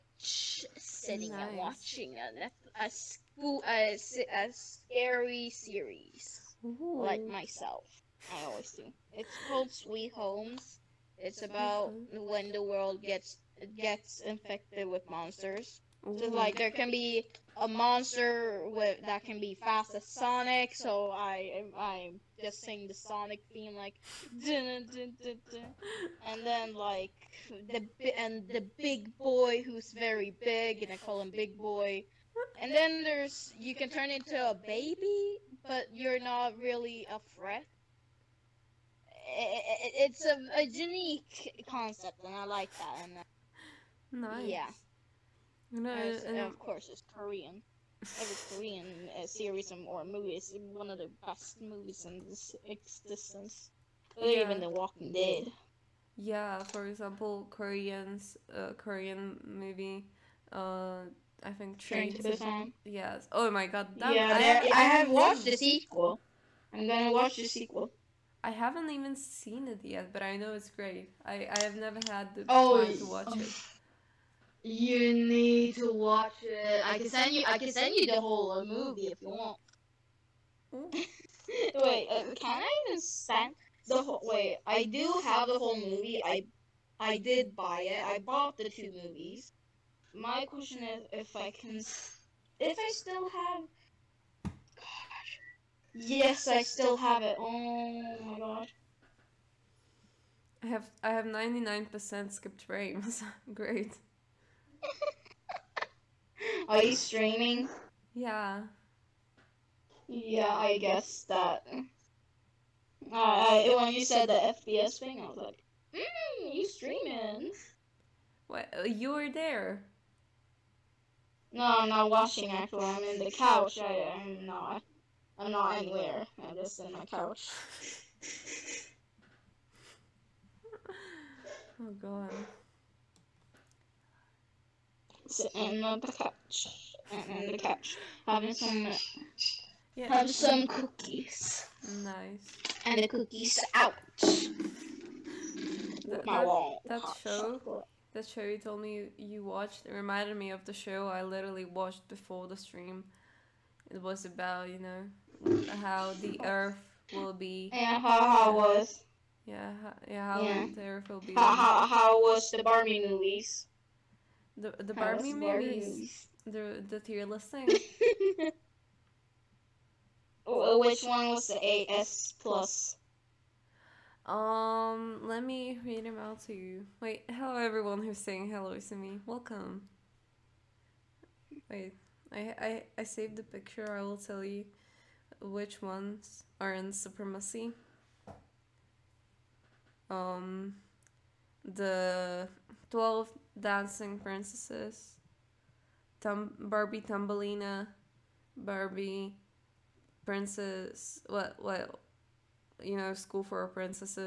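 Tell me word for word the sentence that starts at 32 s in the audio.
And then there's you can turn into a baby, but you're not really a threat.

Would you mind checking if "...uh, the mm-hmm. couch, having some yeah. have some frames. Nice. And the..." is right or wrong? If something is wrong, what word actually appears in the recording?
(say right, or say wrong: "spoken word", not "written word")
wrong: "cookies", not "frames".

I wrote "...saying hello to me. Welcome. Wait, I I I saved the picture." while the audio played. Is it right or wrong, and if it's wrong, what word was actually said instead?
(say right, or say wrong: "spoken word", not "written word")
right.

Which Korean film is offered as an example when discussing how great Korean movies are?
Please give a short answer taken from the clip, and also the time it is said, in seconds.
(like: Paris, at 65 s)
Train to Busan, at 61 s.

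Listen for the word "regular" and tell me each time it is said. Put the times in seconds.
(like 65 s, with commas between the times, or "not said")
not said.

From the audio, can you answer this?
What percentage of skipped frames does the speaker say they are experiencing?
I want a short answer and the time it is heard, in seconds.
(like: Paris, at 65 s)
99%, at 101 s.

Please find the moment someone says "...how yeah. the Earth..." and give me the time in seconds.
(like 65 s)
160 s.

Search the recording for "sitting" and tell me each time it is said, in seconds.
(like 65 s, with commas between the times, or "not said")
0 s, 135 s.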